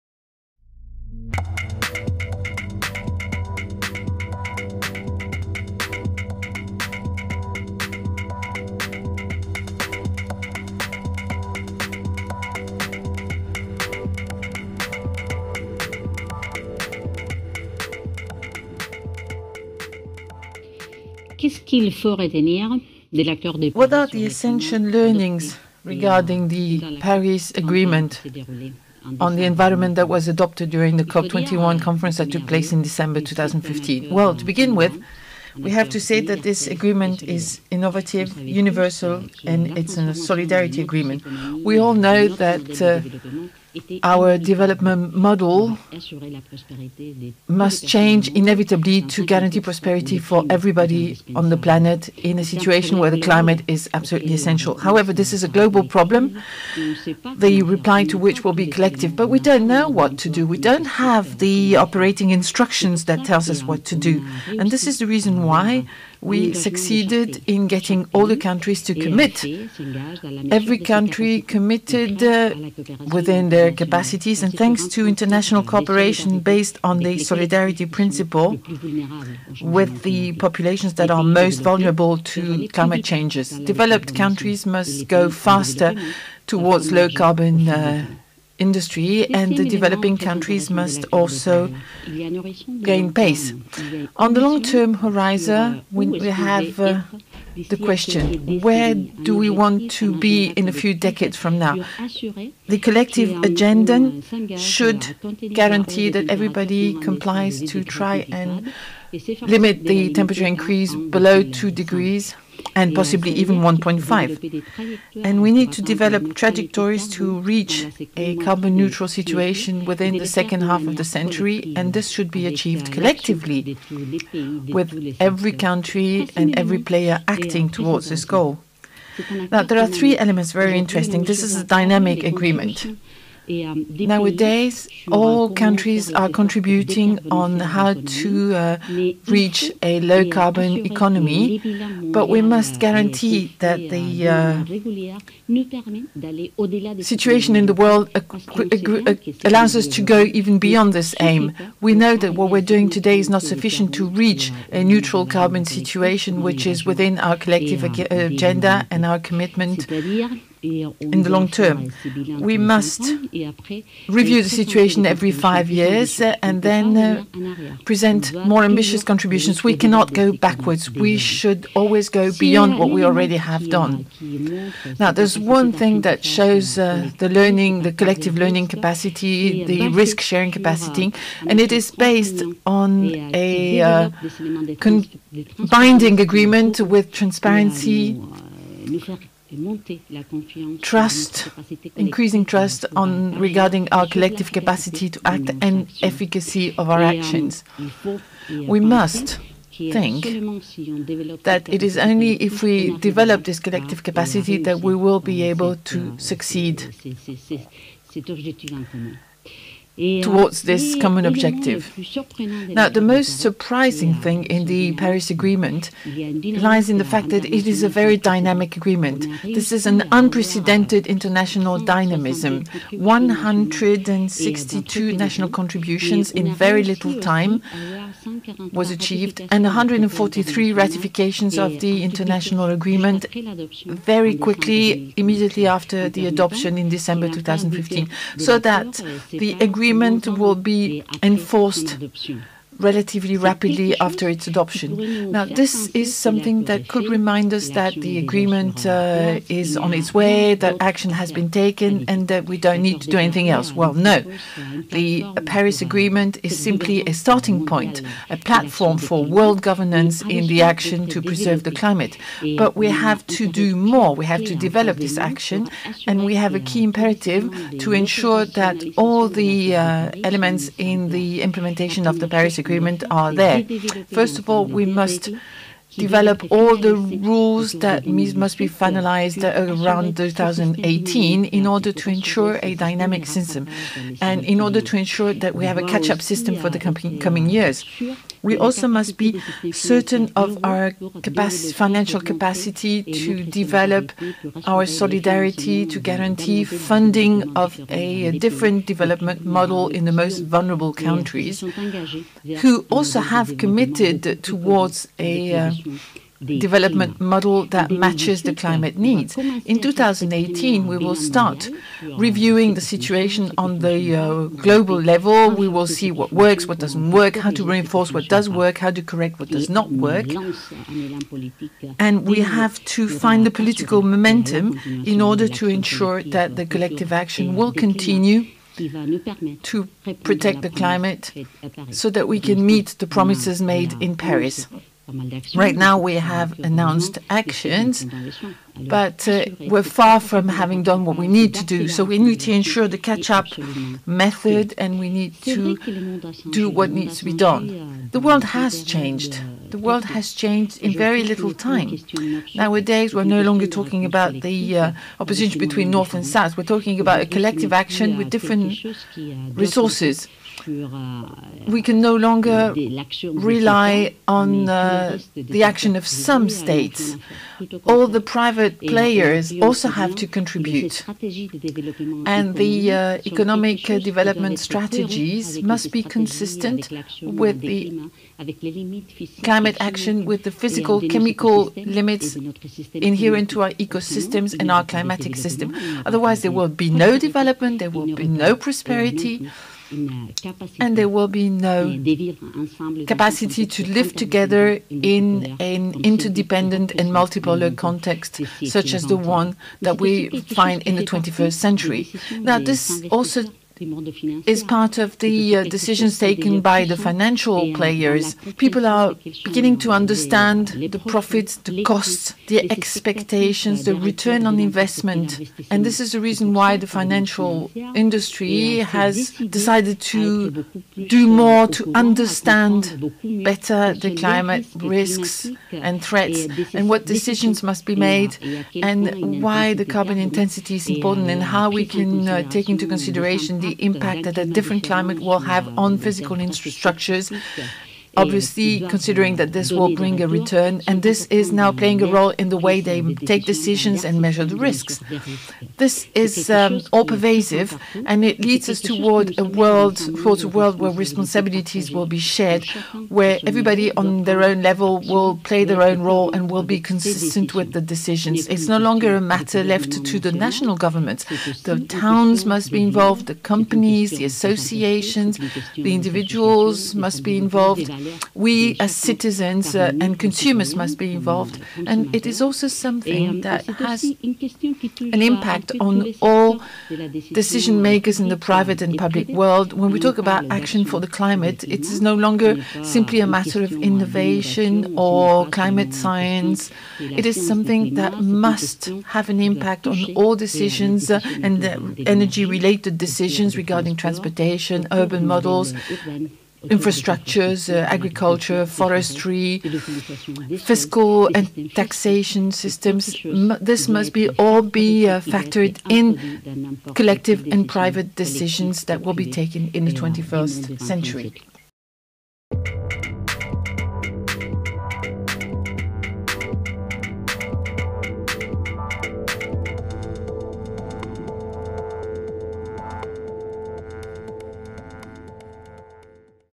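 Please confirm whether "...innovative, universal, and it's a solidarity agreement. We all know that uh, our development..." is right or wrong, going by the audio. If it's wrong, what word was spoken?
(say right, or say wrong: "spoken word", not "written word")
right.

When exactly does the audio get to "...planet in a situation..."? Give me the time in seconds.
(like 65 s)
51 s.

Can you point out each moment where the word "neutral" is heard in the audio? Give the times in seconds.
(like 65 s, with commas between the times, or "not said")
118 s, 154 s.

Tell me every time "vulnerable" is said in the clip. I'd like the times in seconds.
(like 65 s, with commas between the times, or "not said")
81 s, 300 s.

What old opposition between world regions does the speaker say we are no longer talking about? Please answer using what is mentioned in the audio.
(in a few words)
North and South.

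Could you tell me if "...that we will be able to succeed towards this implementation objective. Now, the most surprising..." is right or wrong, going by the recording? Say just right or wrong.
wrong.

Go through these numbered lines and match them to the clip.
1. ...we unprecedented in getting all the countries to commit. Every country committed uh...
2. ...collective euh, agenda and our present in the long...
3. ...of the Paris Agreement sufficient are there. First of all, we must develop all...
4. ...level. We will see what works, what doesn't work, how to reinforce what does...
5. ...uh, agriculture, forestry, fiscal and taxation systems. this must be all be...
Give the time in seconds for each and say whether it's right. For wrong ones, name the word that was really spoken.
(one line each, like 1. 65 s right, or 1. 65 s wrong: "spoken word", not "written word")
1. 66 s wrong: "succeeded", not "unprecedented"
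2. 157 s wrong: "commitment", not "present"
3. 272 s wrong: "agreement", not "sufficient"
4. 314 s right
5. 497 s right.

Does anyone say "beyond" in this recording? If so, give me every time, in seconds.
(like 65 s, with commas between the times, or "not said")
150 s, 172 s.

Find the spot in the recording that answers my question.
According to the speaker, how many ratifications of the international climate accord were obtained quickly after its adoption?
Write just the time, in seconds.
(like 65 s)
229 s.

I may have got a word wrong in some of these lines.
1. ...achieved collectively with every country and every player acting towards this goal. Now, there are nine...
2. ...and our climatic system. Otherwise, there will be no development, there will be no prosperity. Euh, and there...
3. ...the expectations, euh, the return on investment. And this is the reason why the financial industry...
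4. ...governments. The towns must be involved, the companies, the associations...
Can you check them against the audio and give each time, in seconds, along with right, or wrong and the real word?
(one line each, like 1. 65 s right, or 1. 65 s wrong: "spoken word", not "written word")
1. 122 s wrong: "three", not "nine"
2. 384 s right
3. 412 s right
4. 460 s right.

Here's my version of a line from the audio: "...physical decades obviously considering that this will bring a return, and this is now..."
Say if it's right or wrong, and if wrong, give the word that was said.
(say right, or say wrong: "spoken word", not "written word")
wrong: "infrastructures", not "decades".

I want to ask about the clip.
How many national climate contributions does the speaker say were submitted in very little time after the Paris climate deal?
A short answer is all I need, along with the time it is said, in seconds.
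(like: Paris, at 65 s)
162, at 222 s.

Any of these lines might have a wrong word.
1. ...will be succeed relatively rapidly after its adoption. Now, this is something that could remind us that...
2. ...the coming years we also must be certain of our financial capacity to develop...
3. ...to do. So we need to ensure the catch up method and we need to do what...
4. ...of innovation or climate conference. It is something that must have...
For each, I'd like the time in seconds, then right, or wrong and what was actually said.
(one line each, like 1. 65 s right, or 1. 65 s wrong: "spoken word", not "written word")
1. 240 s wrong: "enforced", not "succeed"
2. 286 s right
3. 341 s right
4. 483 s wrong: "science", not "conference".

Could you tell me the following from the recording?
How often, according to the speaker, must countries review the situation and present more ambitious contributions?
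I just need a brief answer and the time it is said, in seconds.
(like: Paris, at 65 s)
every 5 years, at 165 s.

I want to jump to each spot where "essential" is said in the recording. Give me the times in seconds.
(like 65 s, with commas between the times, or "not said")
24 s, 54 s.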